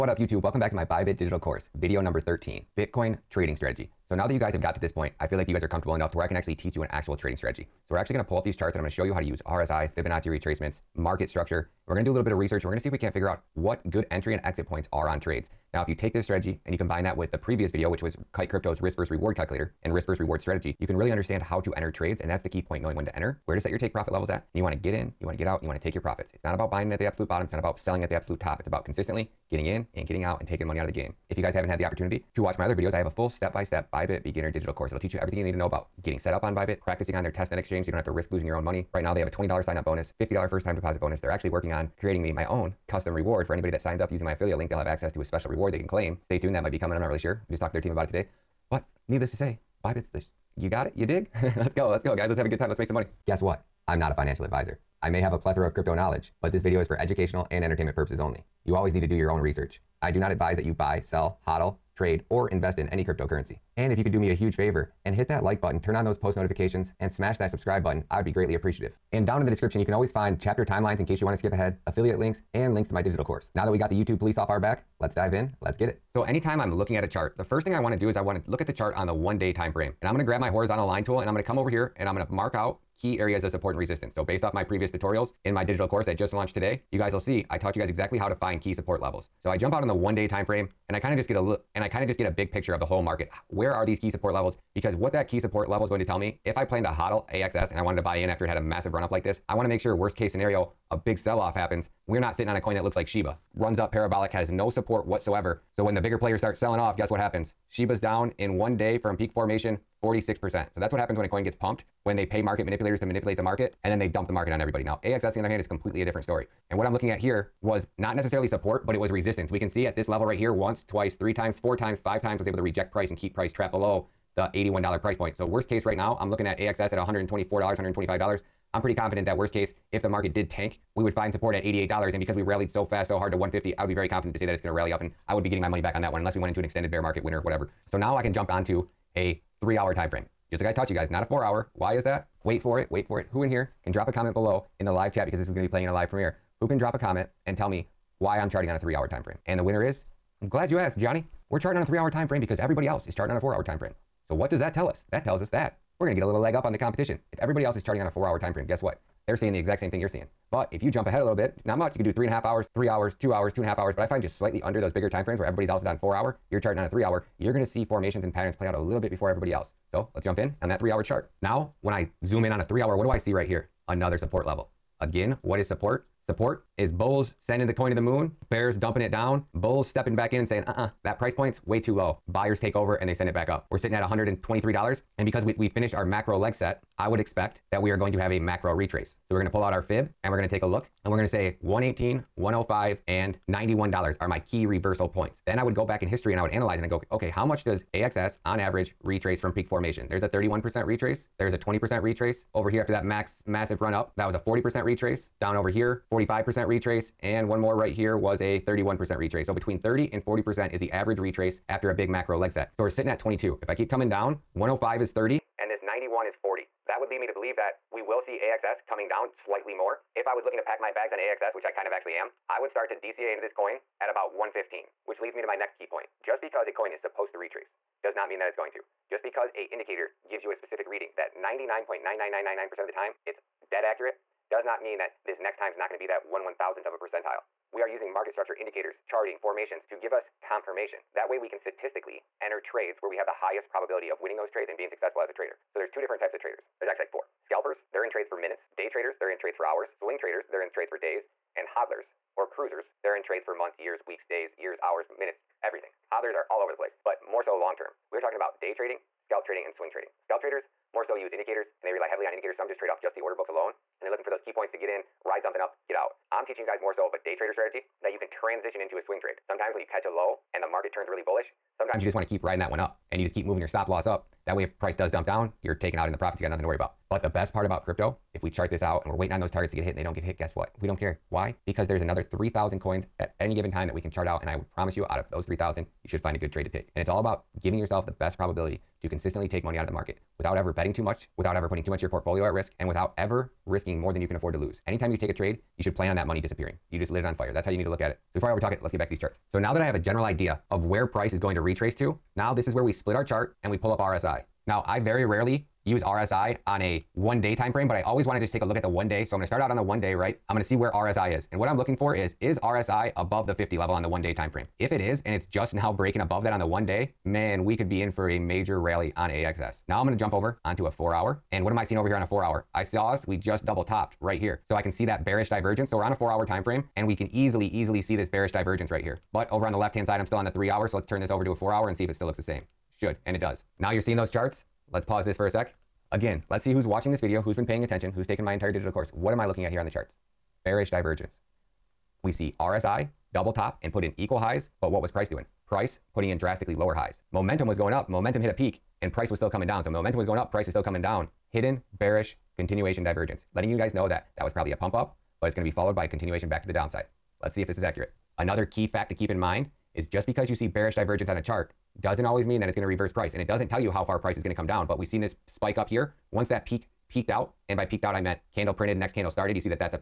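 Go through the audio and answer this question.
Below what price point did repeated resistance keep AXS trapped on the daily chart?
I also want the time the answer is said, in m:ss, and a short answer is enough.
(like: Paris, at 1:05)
$81, at 2:04.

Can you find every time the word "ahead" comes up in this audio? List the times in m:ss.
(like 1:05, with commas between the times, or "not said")
1:11, 2:41.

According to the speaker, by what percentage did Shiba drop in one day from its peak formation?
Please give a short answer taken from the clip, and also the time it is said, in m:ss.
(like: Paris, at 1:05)
46%, at 1:50.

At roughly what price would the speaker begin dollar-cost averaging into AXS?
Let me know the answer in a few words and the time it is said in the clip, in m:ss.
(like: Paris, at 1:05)
115, at 3:44.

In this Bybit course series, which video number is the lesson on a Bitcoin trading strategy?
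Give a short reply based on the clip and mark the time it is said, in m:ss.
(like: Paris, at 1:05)
13, at 0:02.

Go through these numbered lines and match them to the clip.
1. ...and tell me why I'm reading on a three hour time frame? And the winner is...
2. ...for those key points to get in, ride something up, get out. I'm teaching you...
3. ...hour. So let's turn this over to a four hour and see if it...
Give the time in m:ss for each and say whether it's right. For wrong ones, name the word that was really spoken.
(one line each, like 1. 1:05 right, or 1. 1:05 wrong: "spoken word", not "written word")
1. 2:27 wrong: "charting", not "reading"
2. 4:24 right
3. 5:30 right.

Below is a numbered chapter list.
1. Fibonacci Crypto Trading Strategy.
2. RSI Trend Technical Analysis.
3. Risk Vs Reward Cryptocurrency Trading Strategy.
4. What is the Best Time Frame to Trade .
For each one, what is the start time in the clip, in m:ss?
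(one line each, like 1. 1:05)
1. 3:16
2. 5:02
3. 0:18
4. 2:09.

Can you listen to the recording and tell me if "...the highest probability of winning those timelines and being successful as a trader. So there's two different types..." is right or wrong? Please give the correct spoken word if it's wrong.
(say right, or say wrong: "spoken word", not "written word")
wrong: "trades", not "timelines".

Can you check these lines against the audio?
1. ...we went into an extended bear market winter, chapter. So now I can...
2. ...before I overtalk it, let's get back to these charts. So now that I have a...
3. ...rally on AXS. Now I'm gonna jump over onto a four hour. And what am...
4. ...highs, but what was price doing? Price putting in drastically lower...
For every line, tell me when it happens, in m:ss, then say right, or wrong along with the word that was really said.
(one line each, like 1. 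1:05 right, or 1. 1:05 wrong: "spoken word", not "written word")
1. 2:16 wrong: "whatever", not "chapter"
2. 4:58 right
3. 5:18 right
4. 5:44 right.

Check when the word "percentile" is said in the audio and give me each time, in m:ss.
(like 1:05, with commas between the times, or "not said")
3:56.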